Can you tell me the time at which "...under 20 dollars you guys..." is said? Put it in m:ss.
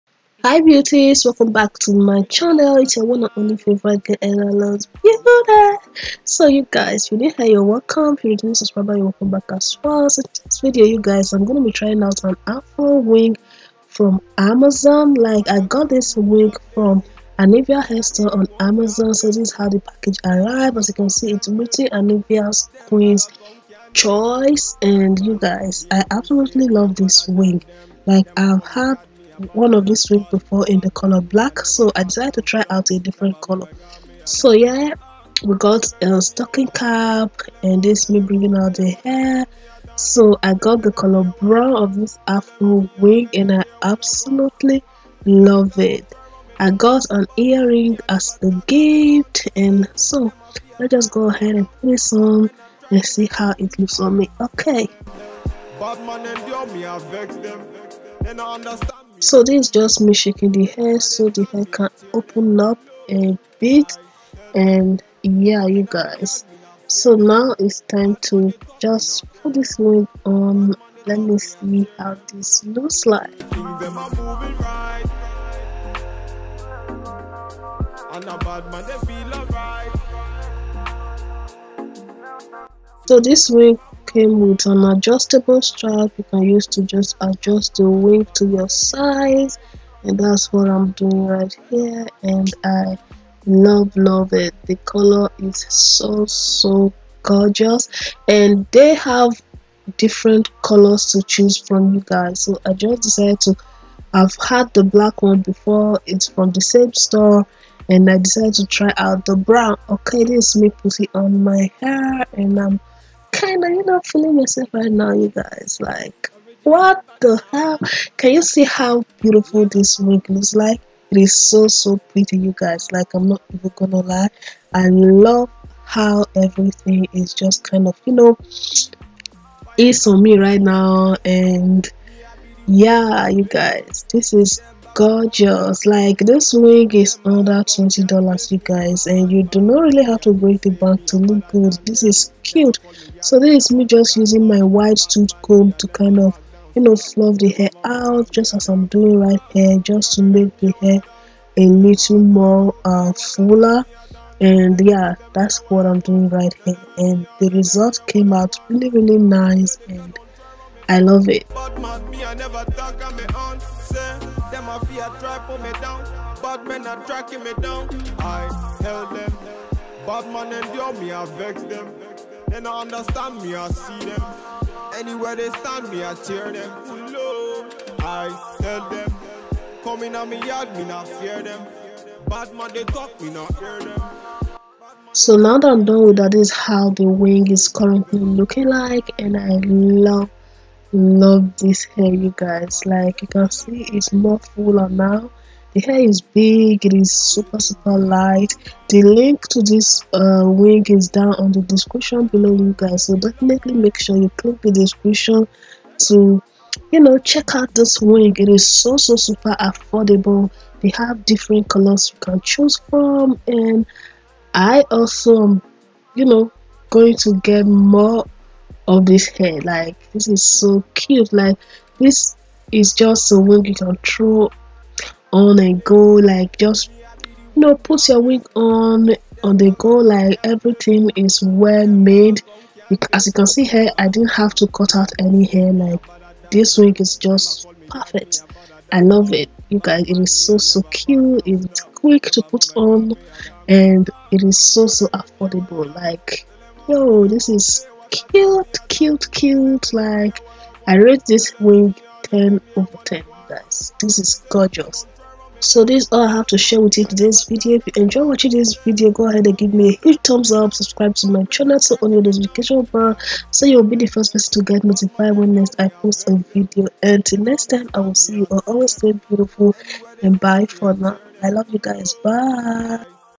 2:17.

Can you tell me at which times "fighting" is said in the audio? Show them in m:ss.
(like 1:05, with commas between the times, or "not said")
not said.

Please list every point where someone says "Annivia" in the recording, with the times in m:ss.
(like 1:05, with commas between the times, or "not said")
0:17, 0:21.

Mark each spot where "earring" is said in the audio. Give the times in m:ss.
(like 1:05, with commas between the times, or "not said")
0:47.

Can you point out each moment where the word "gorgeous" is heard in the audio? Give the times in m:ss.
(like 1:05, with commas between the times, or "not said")
1:37, 2:14, 4:14.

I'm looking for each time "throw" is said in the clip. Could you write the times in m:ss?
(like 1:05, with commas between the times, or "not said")
3:43.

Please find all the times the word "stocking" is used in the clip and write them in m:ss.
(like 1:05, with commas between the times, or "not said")
0:36.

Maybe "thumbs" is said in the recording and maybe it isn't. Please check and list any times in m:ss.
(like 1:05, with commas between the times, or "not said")
4:20.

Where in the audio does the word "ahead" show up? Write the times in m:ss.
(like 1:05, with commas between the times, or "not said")
0:51, 4:19.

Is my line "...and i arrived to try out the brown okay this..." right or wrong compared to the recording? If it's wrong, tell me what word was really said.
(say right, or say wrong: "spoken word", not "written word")
wrong: "decided", not "arrived".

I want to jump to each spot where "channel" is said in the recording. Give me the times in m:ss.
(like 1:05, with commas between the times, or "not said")
0:02, 4:21.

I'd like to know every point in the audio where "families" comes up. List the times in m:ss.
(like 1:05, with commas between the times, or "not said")
not said.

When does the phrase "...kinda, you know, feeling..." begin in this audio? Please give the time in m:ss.
1:53.